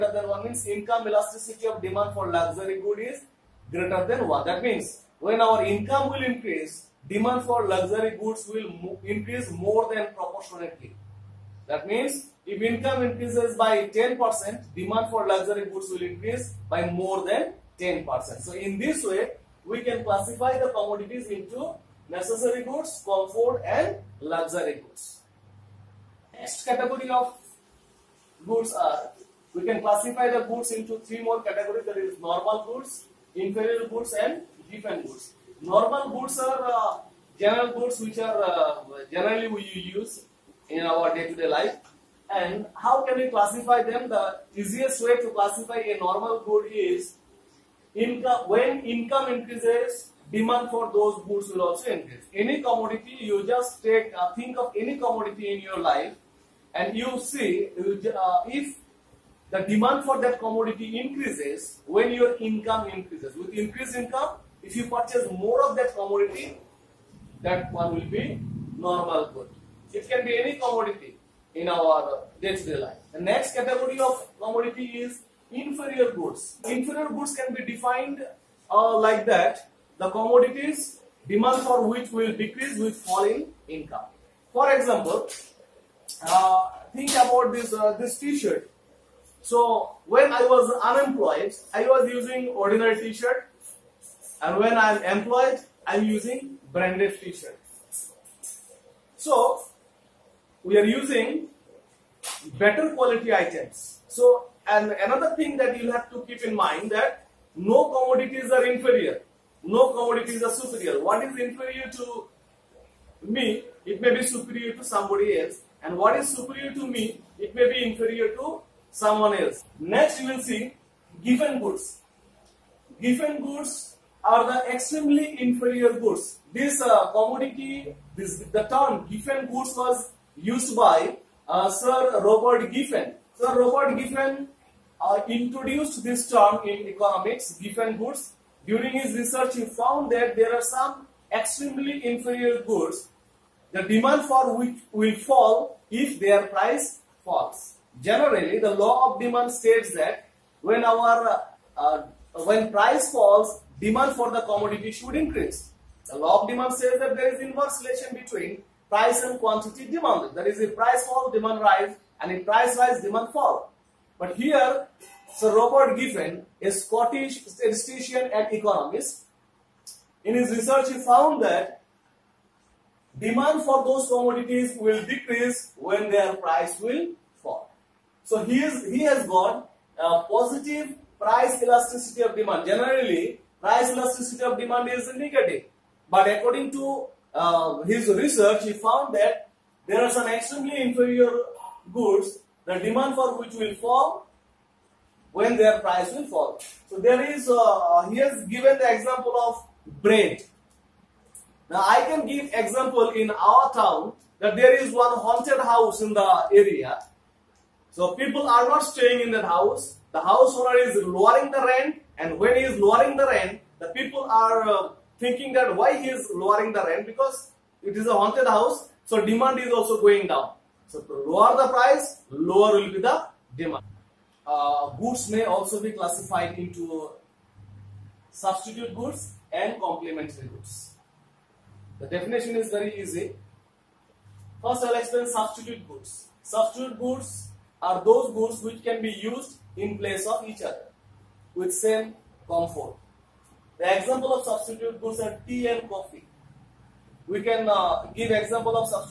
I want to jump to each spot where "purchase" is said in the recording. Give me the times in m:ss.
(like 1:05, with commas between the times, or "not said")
1:04.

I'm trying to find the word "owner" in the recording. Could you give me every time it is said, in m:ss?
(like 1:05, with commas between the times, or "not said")
3:30.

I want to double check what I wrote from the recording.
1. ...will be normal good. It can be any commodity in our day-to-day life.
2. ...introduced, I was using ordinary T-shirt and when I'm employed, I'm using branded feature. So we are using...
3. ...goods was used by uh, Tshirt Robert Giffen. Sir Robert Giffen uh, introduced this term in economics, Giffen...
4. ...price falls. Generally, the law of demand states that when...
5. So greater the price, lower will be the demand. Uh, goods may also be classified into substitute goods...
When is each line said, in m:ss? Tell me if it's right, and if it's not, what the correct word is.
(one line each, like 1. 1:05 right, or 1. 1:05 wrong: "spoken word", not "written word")
1. 1:07 right
2. 1:30 wrong: "unemployed", not "introduced"
3. 2:09 wrong: "Sir", not "Tshirt"
4. 2:26 right
5. 3:40 wrong: "lower", not "greater".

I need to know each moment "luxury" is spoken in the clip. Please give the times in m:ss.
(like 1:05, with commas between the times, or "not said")
0:02, 0:07, 0:15, 0:24.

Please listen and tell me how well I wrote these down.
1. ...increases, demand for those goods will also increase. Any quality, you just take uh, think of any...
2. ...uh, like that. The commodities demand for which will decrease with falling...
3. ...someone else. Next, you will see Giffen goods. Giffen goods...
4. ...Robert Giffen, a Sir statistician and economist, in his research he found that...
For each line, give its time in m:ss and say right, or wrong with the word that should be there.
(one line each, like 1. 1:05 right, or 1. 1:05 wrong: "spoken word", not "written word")
1. 0:49 wrong: "commodity", not "quality"
2. 1:18 right
3. 1:58 right
4. 2:45 wrong: "Scottish", not "Sir".